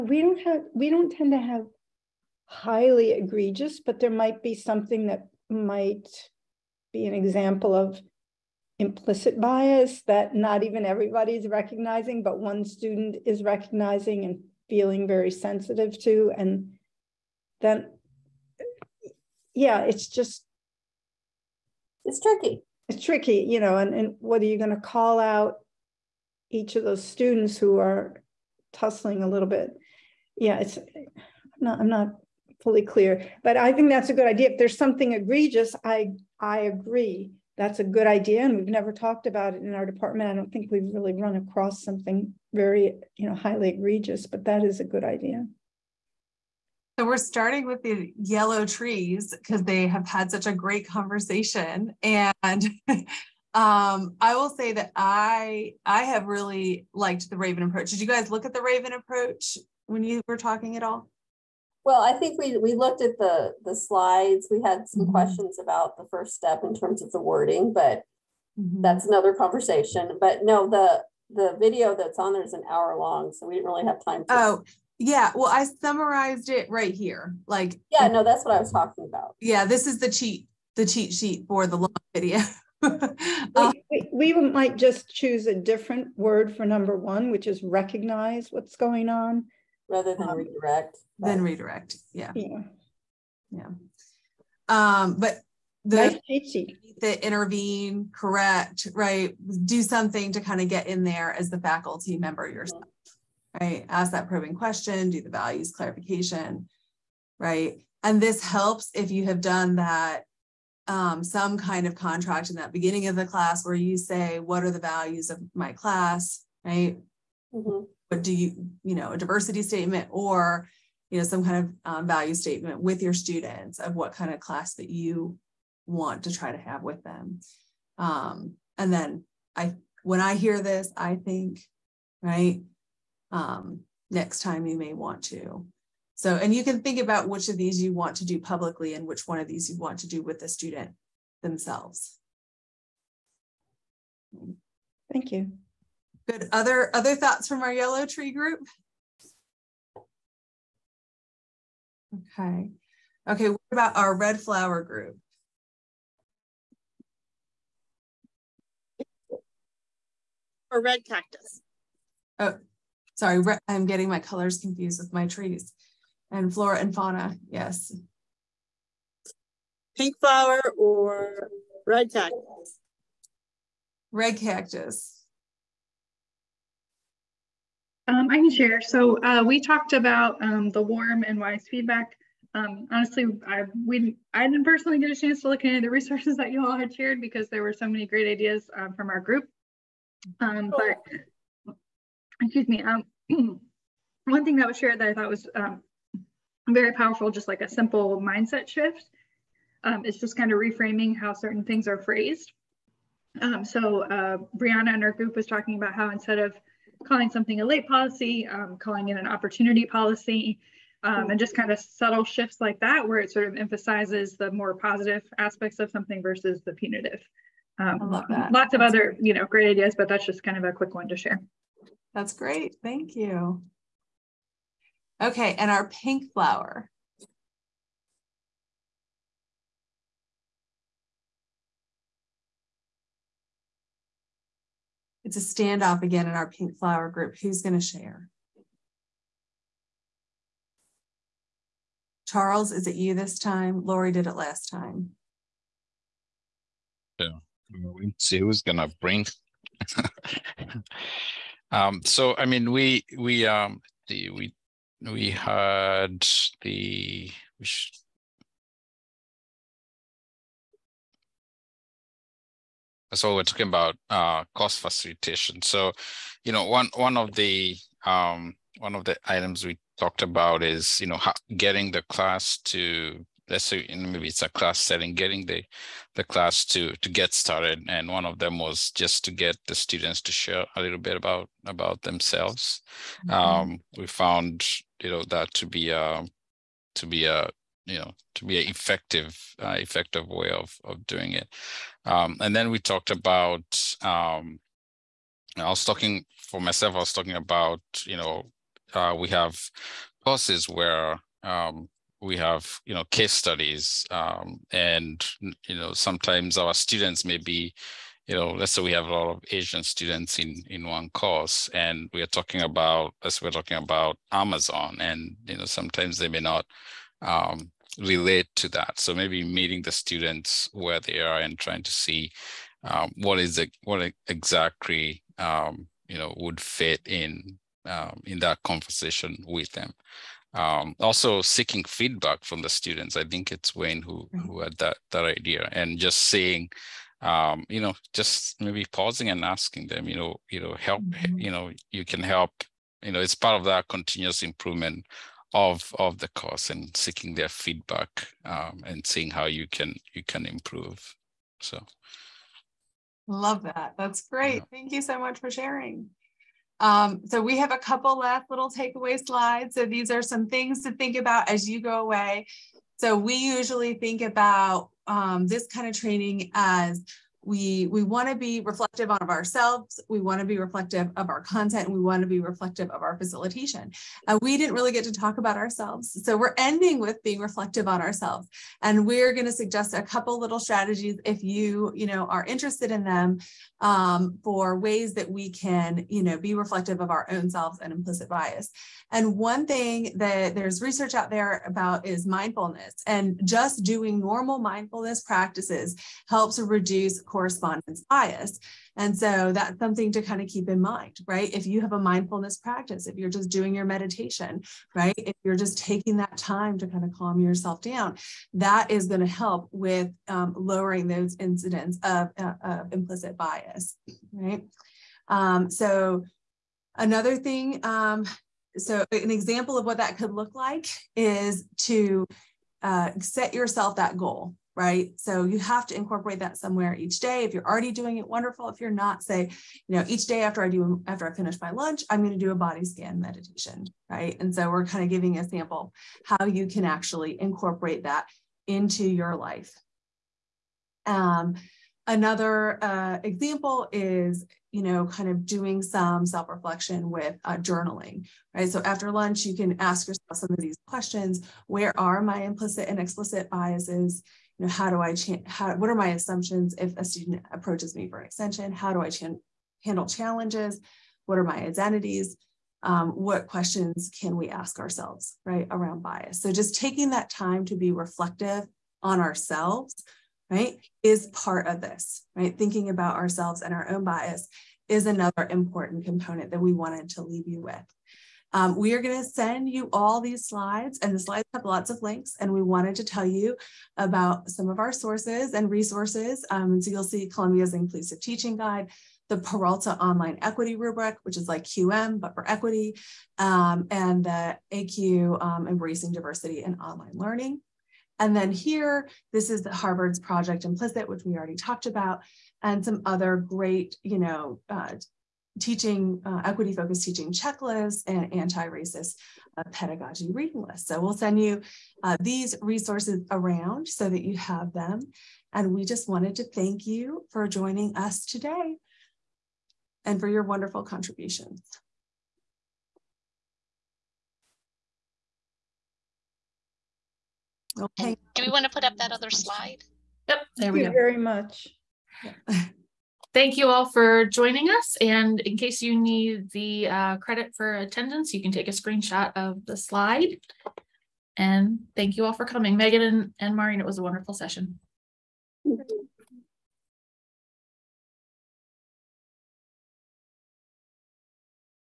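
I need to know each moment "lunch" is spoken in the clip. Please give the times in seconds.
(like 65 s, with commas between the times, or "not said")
431 s, 449 s.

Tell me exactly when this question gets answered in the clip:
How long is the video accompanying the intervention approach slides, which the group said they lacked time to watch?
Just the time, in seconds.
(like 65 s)
72 s.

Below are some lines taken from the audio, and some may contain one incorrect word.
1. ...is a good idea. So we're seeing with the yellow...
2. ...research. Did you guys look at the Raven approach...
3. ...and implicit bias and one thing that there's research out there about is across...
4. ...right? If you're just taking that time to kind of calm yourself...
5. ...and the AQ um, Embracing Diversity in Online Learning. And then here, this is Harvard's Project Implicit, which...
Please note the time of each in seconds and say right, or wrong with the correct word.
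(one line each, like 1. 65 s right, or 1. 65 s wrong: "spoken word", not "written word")
1. 44 s wrong: "starting", not "seeing"
2. 57 s wrong: "approach", not "research"
3. 387 s wrong: "mindfulness", not "across"
4. 404 s right
5. 493 s right.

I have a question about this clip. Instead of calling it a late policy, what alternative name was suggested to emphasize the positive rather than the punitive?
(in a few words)
opportunity policy.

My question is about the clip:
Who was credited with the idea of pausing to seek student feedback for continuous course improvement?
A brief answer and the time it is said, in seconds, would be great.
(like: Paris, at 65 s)
Wayne, at 333 s.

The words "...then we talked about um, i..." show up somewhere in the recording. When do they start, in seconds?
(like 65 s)
292 s.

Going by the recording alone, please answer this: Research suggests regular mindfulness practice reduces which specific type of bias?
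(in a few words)
correspondence bias.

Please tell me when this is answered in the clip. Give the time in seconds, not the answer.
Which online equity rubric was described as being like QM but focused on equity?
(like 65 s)
489 s.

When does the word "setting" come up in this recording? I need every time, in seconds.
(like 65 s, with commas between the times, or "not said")
274 s.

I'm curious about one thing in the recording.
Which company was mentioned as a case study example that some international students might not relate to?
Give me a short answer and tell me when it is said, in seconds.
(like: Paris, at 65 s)
Amazon, at 314 s.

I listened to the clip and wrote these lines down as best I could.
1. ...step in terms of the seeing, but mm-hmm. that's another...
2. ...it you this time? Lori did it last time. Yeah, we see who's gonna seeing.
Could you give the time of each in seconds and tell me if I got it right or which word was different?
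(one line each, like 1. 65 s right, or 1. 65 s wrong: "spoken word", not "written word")
1. 66 s wrong: "wording", not "seeing"
2. 242 s wrong: "bring", not "seeing".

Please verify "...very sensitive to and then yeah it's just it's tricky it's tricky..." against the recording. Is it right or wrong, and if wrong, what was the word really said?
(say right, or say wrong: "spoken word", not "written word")
right.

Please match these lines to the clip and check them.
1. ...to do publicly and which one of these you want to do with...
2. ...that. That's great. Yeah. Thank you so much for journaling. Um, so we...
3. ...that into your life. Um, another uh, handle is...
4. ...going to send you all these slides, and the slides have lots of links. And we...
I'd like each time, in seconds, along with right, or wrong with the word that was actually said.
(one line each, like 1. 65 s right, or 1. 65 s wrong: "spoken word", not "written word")
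1. 138 s right
2. 353 s wrong: "sharing", not "journaling"
3. 438 s wrong: "example", not "handle"
4. 479 s right.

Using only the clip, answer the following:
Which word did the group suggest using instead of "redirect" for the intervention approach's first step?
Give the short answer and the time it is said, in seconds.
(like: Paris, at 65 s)
recognize, at 87 s.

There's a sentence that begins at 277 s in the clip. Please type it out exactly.
And one of them was just to get the students to share a little bit about about themselves.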